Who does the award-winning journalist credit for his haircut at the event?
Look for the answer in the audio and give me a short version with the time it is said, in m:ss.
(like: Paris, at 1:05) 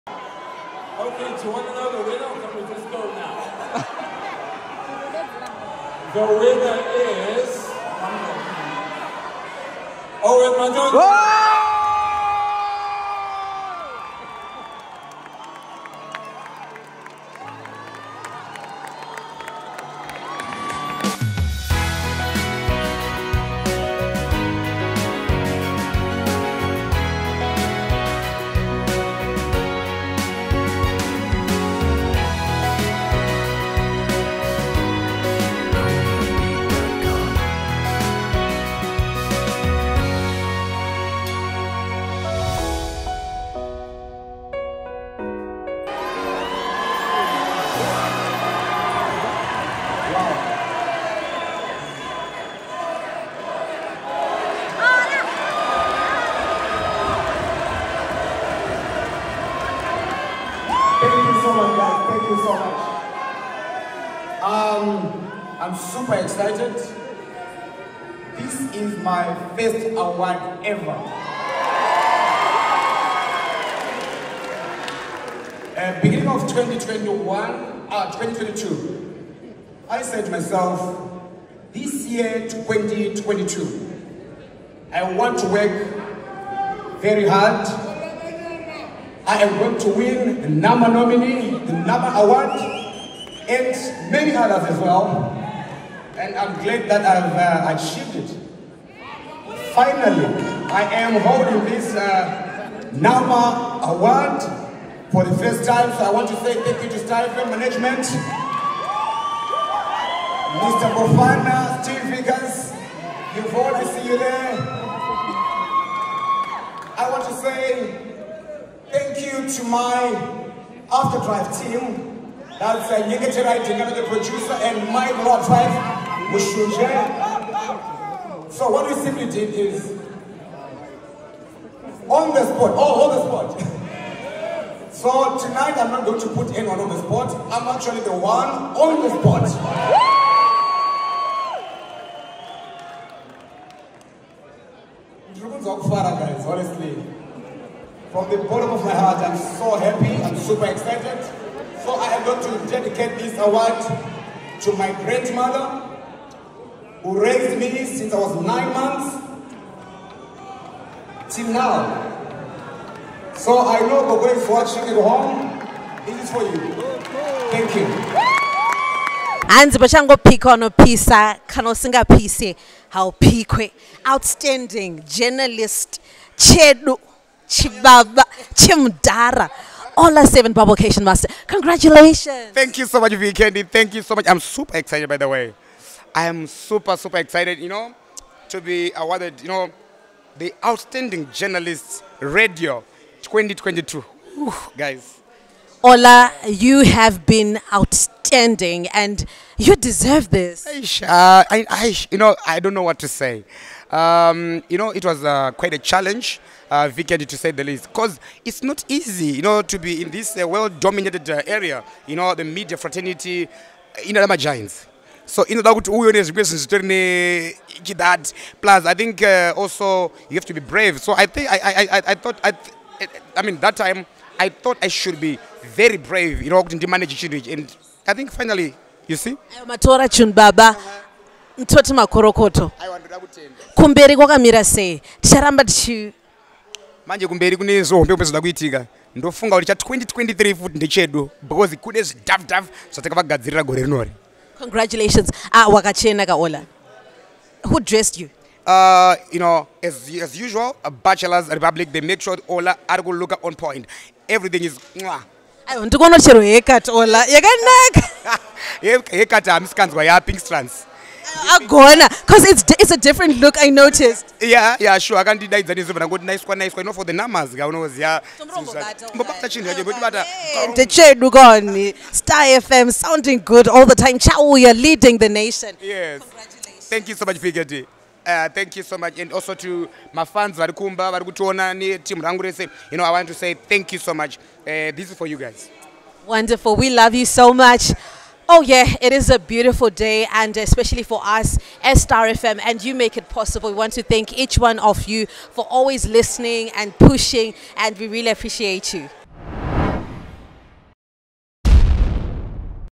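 Pink Strands, at 4:20.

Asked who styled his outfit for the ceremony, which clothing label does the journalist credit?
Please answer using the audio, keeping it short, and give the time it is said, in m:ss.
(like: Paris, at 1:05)
Bachelor's Republic, at 4:10.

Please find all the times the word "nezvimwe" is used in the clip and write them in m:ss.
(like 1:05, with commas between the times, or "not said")
3:36.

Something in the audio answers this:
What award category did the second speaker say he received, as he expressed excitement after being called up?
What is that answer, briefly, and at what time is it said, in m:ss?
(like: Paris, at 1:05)
Outstanding Journalist Radio, at 3:10.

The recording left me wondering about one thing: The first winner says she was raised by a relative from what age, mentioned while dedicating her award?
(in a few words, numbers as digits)
9 months.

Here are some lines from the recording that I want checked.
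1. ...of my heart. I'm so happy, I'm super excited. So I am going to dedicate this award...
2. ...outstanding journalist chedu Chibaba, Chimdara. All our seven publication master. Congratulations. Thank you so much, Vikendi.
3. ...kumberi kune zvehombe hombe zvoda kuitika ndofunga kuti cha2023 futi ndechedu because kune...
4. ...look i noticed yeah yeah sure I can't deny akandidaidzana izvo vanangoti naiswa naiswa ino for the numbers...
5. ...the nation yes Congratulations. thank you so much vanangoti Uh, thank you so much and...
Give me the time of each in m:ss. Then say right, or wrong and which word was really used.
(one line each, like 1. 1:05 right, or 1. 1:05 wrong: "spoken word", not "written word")
1. 2:28 right
2. 2:54 right
3. 3:57 right
4. 4:23 right
5. 4:35 wrong: "pigati", not "vanangoti".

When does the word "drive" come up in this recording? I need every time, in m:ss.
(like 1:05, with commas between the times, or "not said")
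2:01, 2:05.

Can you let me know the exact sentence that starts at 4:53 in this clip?
We want to thank each one of you for always listening and pushing and we really appreciate you.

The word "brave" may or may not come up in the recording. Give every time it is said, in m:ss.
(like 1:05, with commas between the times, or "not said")
3:40, 3:45.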